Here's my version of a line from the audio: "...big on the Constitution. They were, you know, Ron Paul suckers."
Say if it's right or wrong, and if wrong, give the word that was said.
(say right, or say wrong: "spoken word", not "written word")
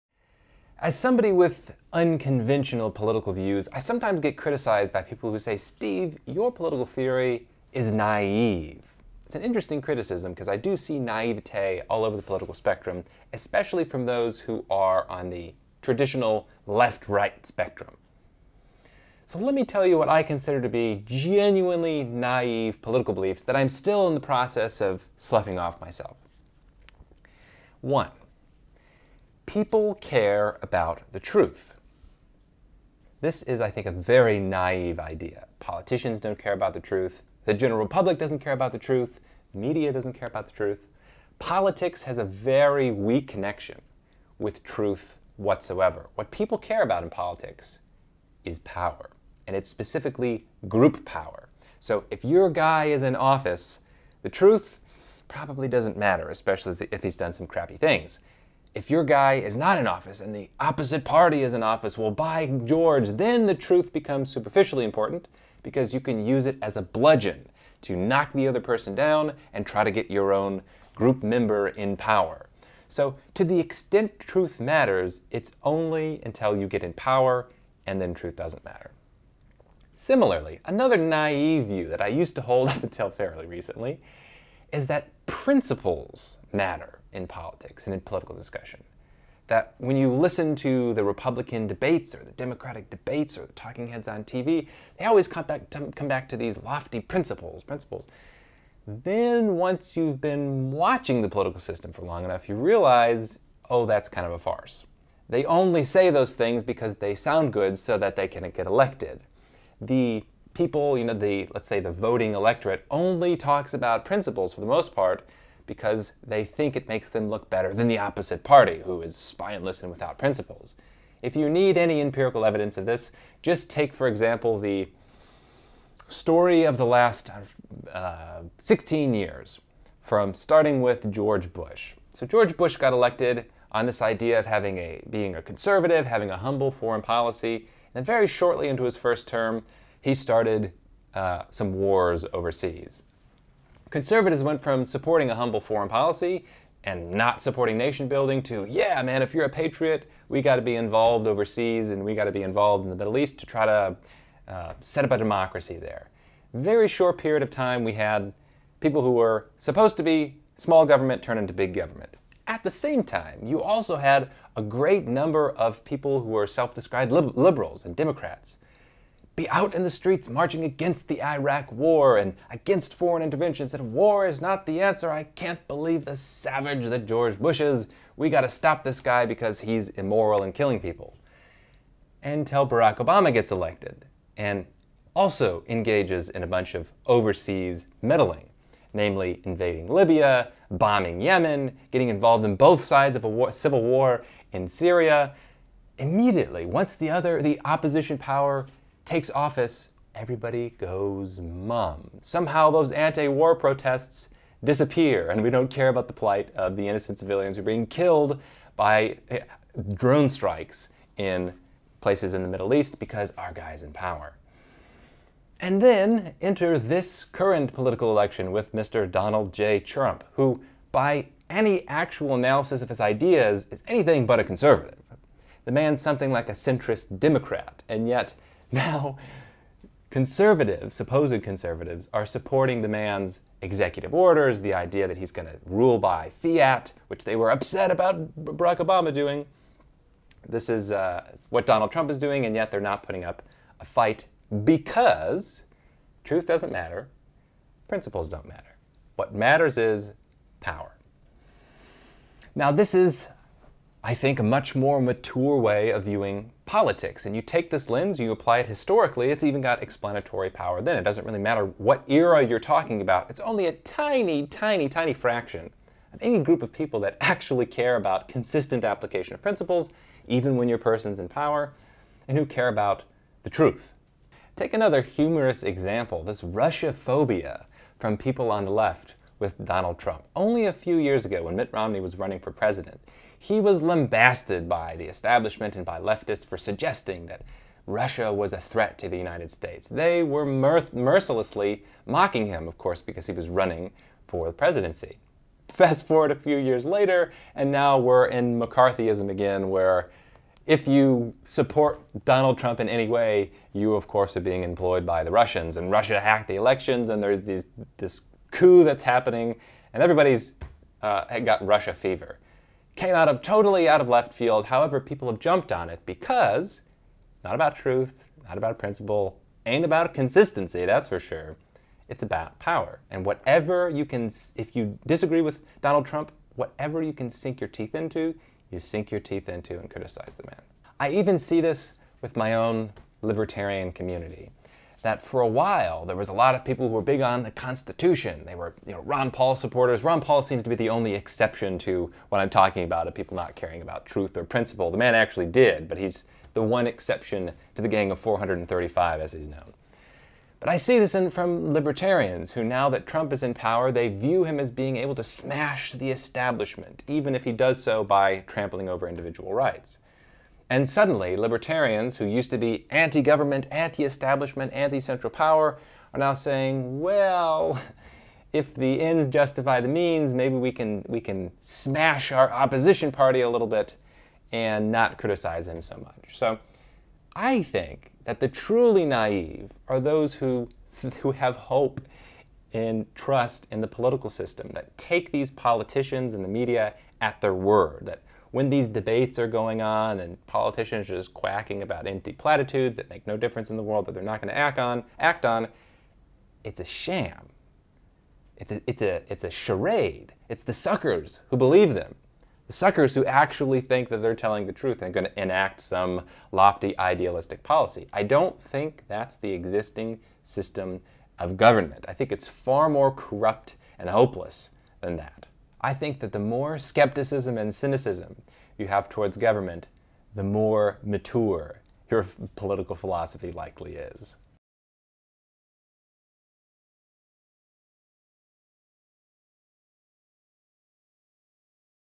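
wrong: "supporters", not "suckers".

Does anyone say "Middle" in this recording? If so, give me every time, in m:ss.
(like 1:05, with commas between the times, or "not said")
2:32, 3:32.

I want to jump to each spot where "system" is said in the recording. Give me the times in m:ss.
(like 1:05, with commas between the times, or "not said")
1:41, 6:24, 6:50.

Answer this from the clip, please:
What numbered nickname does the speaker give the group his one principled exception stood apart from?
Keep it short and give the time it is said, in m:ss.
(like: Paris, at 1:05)
Gang of 435, at 5:47.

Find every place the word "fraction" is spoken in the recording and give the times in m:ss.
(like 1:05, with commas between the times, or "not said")
4:25.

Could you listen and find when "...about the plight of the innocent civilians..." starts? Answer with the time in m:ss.
3:25.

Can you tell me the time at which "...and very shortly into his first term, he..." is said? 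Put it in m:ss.
2:17.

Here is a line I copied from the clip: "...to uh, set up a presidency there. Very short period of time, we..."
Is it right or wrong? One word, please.
wrong.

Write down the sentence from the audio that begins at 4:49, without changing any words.
They were mercilessly mocking him, of course, because he was running for the presidency.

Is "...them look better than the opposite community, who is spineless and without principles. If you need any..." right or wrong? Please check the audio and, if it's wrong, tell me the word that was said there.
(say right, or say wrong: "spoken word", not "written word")
wrong: "party", not "community".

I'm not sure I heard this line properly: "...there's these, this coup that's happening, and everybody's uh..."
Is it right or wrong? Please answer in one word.
right.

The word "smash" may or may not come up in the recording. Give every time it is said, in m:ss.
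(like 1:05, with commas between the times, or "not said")
5:55, 6:11.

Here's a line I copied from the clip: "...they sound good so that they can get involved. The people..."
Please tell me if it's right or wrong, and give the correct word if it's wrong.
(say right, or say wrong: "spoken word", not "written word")
wrong: "elected", not "involved".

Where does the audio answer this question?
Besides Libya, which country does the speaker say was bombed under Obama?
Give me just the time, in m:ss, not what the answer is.
3:11.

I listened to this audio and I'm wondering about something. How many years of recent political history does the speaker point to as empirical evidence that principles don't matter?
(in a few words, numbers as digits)
16.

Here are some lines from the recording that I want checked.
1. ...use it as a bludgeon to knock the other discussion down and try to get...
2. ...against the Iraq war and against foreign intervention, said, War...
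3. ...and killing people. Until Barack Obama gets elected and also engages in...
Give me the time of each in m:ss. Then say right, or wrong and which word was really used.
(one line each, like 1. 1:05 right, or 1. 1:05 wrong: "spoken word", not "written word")
1. 1:06 wrong: "person", not "discussion"
2. 2:50 right
3. 3:00 right.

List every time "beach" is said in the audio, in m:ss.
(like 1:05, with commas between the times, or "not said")
not said.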